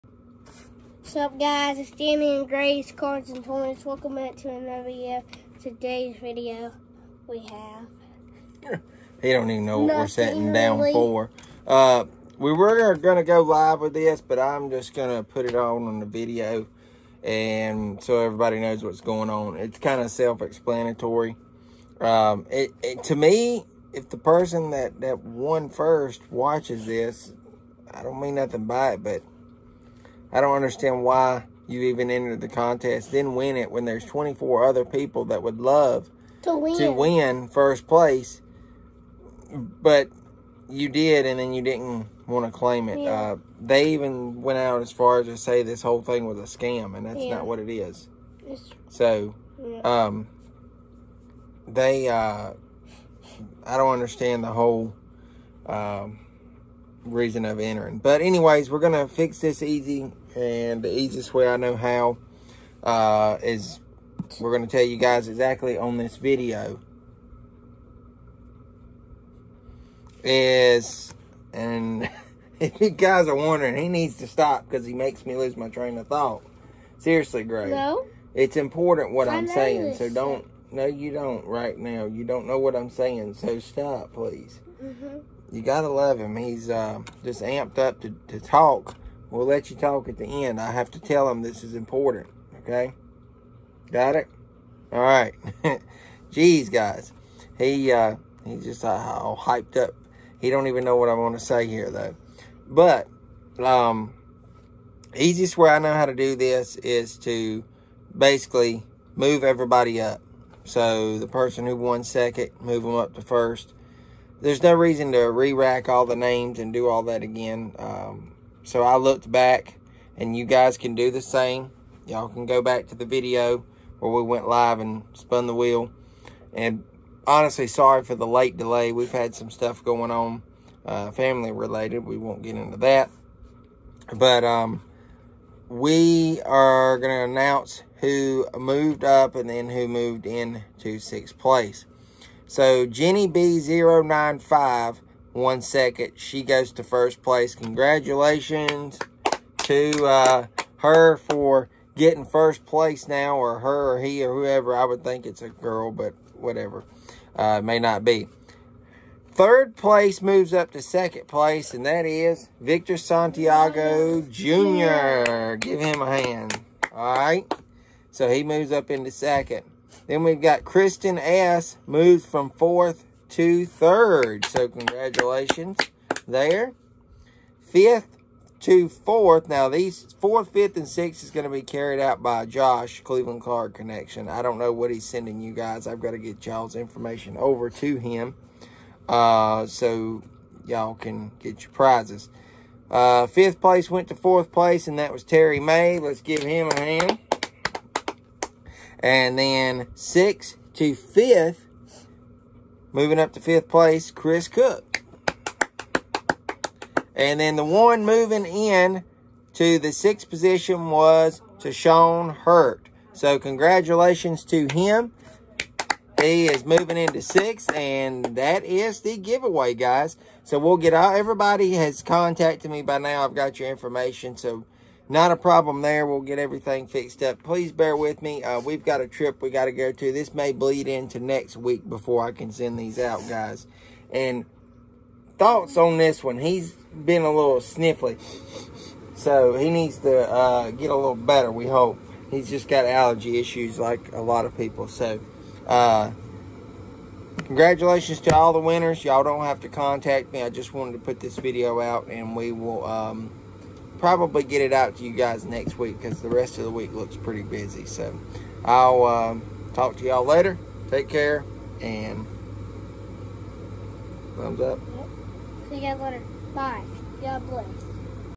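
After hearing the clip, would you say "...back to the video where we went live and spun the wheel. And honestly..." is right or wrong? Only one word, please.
right.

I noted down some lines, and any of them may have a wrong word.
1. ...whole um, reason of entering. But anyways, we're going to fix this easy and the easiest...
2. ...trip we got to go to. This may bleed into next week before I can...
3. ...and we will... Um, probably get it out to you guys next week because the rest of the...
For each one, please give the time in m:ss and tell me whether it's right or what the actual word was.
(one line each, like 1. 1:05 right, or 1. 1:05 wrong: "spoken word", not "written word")
1. 0:54 right
2. 3:49 right
3. 4:12 right.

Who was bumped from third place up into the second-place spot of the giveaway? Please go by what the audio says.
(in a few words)
Victor Santiago Jr.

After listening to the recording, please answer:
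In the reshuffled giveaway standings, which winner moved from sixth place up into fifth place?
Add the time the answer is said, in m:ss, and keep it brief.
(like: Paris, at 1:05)
Chris Cook, at 3:24.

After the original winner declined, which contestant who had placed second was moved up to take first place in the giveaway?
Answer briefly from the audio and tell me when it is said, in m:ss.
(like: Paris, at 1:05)
Jenny B095, at 2:22.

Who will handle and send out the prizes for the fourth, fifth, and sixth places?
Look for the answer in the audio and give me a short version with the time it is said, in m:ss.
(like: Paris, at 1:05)
Josh Cleveland Card Connection, at 3:02.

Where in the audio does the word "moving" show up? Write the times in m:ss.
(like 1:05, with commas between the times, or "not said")
3:22, 3:28, 3:36.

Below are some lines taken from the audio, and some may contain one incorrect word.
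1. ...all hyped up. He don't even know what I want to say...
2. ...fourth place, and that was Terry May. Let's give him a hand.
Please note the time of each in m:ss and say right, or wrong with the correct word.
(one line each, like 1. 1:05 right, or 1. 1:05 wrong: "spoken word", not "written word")
1. 1:38 right
2. 3:14 right.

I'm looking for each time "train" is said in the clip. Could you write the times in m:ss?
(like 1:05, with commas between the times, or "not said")
1:15.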